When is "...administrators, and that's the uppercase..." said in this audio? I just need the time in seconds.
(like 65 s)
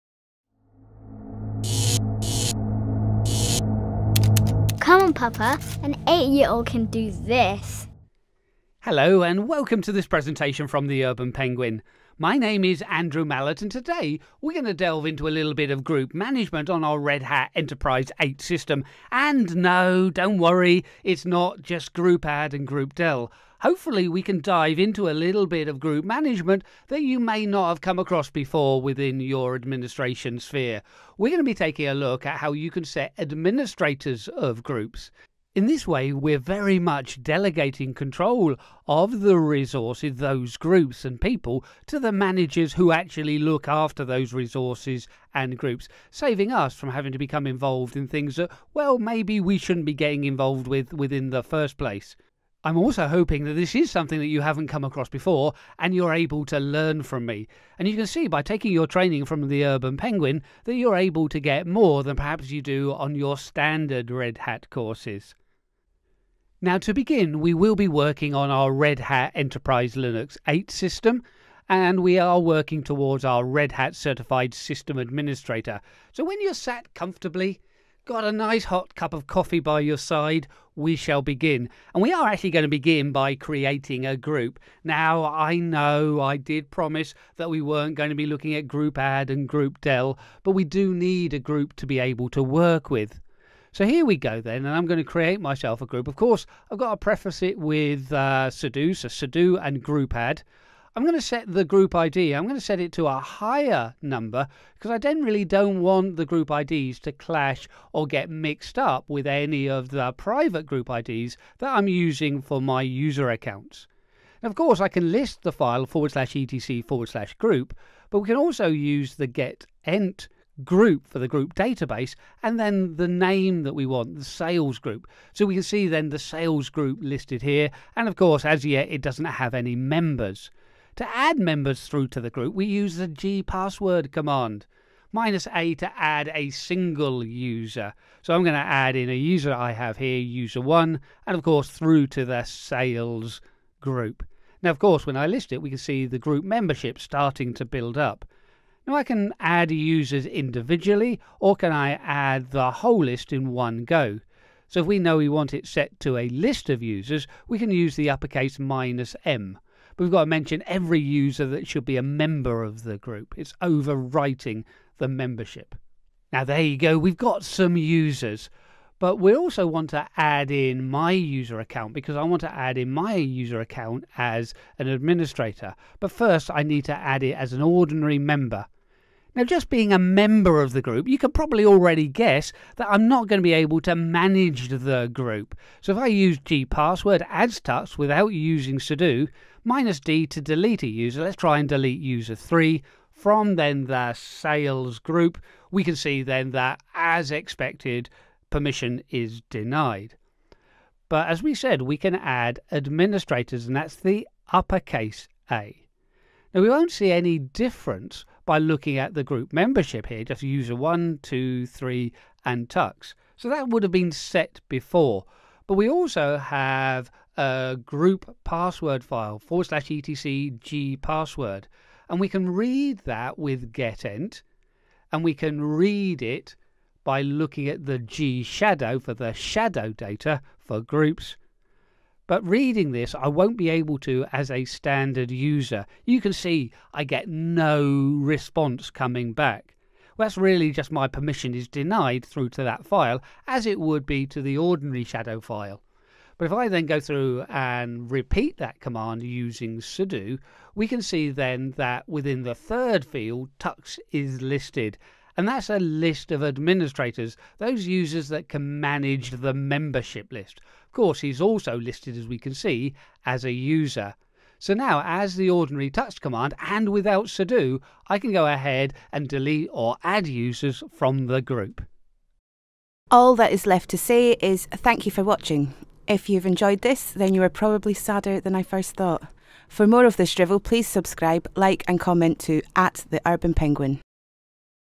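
202 s.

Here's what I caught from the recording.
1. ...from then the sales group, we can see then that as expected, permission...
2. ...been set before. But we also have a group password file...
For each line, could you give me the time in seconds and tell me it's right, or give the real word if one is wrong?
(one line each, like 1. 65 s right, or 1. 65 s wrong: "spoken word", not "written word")
1. 193 s right
2. 213 s right.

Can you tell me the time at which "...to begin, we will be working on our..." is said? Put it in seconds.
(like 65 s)
66 s.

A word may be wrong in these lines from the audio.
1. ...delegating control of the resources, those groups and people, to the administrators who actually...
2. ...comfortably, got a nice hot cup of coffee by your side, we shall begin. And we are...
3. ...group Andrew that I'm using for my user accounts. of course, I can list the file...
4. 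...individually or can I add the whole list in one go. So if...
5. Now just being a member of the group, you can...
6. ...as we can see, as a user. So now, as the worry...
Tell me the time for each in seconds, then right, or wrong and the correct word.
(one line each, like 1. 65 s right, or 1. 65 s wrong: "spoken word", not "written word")
1. 37 s wrong: "managers", not "administrators"
2. 76 s right
3. 110 s wrong: "IDs", not "Andrew"
4. 150 s right
5. 179 s right
6. 262 s wrong: "ordinary", not "worry".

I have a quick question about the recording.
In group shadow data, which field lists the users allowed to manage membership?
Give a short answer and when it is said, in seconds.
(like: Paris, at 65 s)
third field, at 252 s.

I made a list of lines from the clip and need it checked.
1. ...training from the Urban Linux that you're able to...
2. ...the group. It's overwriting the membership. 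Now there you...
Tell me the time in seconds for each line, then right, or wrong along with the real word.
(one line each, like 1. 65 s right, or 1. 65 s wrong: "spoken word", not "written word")
1. 58 s wrong: "Penguin", not "Linux"
2. 162 s right.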